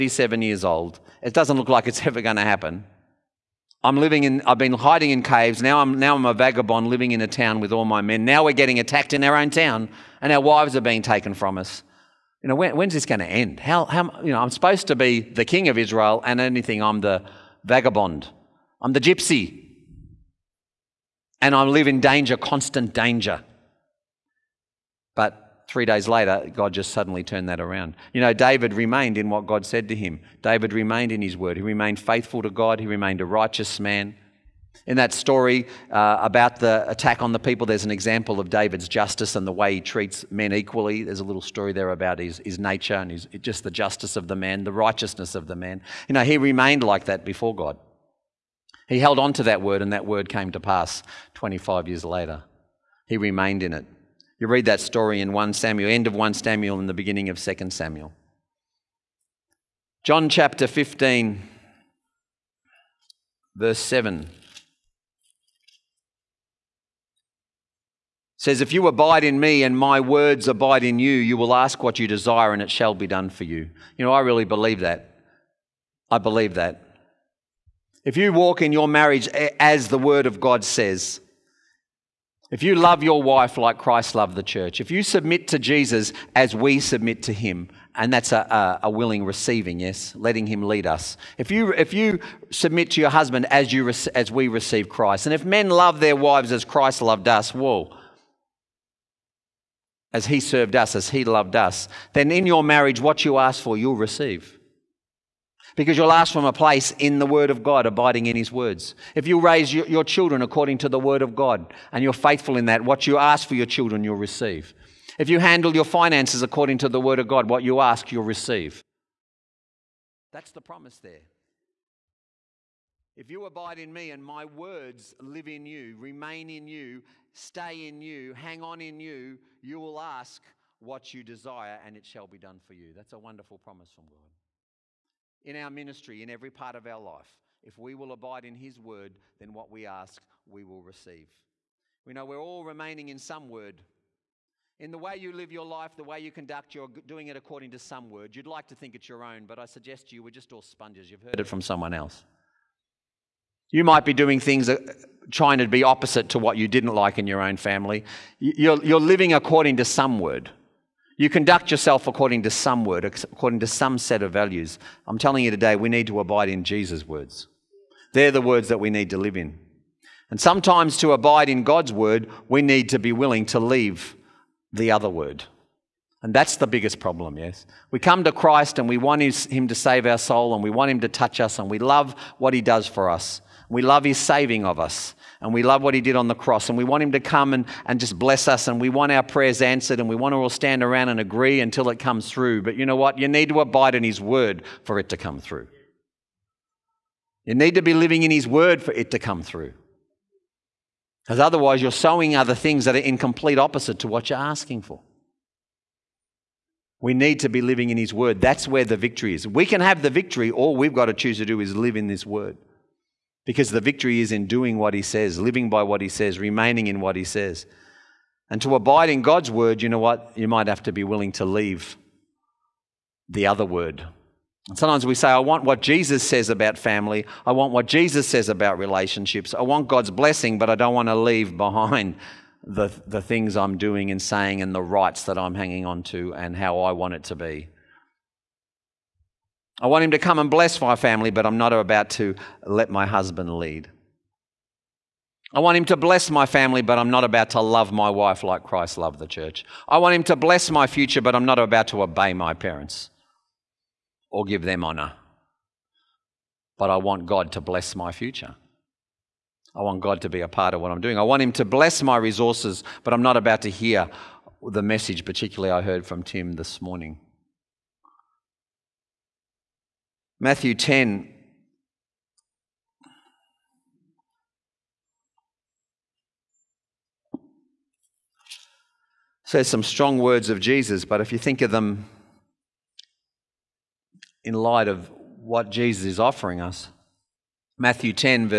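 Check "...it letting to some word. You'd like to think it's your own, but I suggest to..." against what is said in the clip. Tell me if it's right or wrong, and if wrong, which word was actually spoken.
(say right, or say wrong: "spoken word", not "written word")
wrong: "according", not "letting".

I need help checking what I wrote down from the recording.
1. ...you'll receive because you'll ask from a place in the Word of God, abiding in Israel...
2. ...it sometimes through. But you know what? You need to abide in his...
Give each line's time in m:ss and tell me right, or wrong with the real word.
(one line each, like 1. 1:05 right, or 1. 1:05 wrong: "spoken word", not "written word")
1. 1:43 wrong: "His", not "Israel"
2. 3:11 wrong: "comes", not "sometimes".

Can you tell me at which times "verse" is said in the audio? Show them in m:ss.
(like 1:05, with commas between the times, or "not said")
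1:03.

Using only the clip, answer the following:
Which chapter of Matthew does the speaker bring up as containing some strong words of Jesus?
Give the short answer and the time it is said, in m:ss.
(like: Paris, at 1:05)
Matthew 10, at 4:30.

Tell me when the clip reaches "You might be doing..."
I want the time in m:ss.
2:33.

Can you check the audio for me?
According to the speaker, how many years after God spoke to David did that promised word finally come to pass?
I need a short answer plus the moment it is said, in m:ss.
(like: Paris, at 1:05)
25 years, at 0:51.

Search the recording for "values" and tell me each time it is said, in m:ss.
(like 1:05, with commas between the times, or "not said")
2:44.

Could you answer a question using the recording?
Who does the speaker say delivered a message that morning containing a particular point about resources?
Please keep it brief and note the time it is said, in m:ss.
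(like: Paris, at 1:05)
Tim, at 4:26.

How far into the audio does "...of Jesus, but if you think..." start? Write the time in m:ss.
4:40.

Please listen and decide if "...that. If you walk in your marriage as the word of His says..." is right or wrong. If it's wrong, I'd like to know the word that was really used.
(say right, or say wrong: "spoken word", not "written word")
wrong: "God", not "His".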